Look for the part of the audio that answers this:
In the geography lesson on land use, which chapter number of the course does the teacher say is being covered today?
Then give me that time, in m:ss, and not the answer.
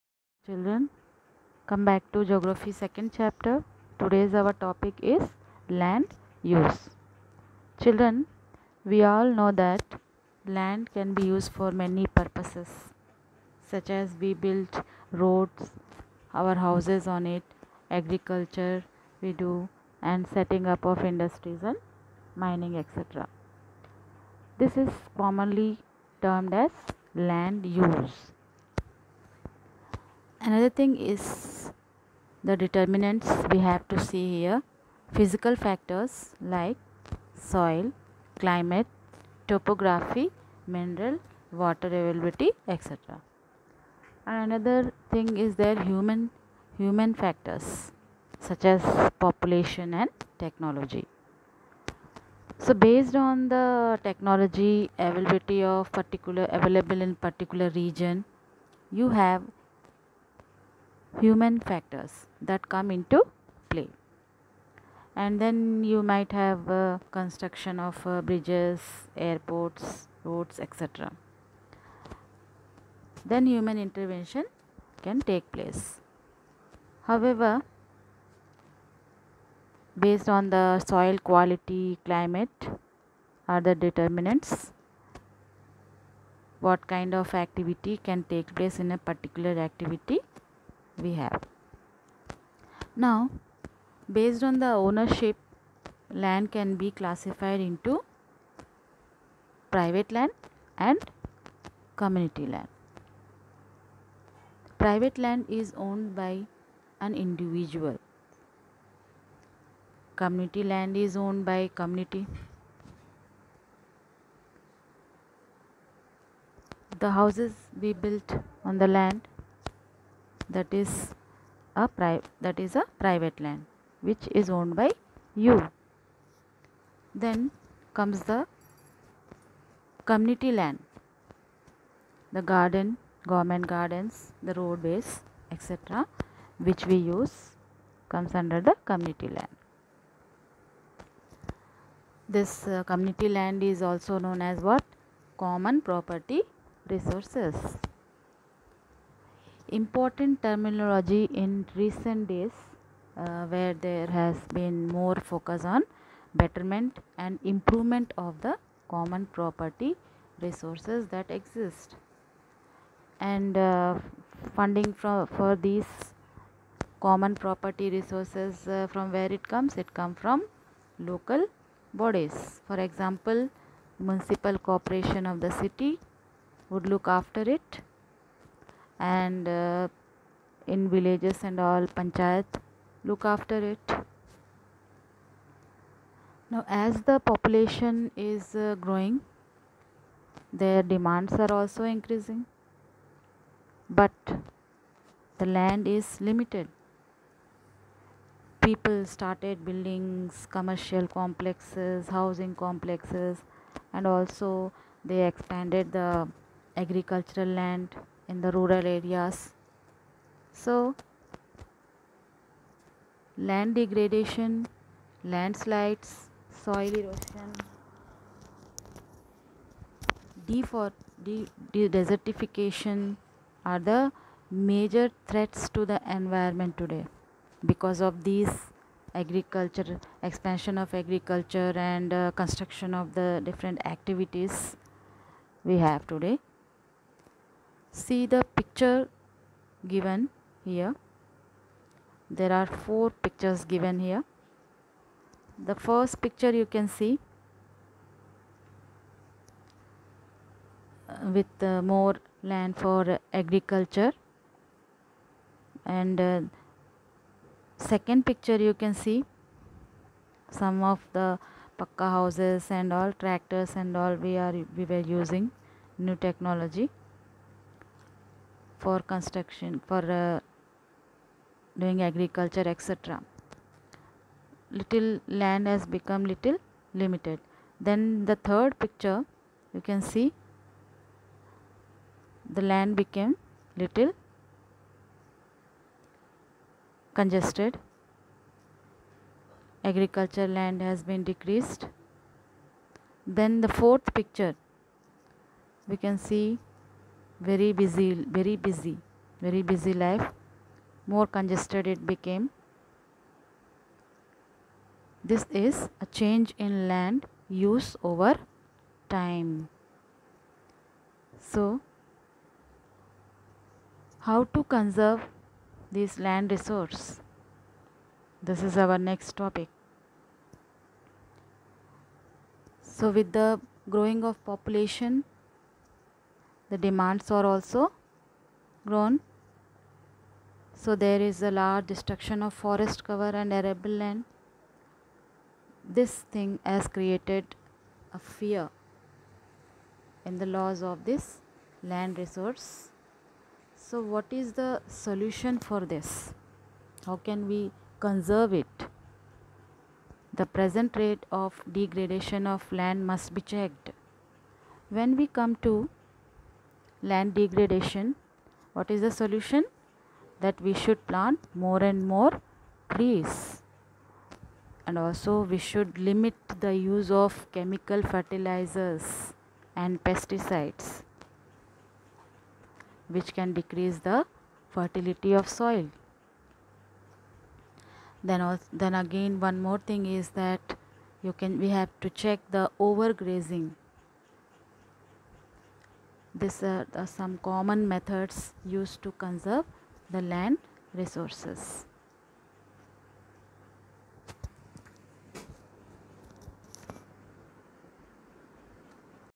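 0:02.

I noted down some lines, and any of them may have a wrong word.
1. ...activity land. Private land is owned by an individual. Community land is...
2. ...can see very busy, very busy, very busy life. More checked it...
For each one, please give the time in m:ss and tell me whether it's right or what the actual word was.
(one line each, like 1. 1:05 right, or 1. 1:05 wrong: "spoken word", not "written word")
1. 1:41 wrong: "community", not "activity"
2. 4:56 wrong: "congested", not "checked".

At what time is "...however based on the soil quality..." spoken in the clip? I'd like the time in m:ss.
1:17.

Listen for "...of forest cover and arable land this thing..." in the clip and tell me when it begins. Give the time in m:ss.
5:32.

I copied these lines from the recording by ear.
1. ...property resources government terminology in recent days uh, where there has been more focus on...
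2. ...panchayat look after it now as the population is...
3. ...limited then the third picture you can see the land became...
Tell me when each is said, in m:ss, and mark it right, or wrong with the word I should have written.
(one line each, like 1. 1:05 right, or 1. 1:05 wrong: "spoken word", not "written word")
1. 2:25 wrong: "important", not "government"
2. 3:01 right
3. 4:37 right.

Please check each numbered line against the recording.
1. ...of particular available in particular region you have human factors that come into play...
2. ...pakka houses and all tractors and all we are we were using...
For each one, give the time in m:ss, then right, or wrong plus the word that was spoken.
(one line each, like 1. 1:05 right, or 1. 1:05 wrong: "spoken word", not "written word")
1. 0:55 right
2. 4:21 right.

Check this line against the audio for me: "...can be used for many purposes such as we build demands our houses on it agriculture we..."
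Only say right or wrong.
wrong.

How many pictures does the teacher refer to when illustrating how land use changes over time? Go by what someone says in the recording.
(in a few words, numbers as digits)
4.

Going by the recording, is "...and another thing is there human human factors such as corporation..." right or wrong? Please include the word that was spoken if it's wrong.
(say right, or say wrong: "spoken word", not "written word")
wrong: "population", not "corporation".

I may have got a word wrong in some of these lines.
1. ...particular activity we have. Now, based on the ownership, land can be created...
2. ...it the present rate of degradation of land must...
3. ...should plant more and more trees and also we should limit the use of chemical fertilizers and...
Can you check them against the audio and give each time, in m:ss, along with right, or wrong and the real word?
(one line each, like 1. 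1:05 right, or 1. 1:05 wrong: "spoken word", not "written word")
1. 1:28 wrong: "classified", not "created"
2. 5:48 right
3. 6:00 right.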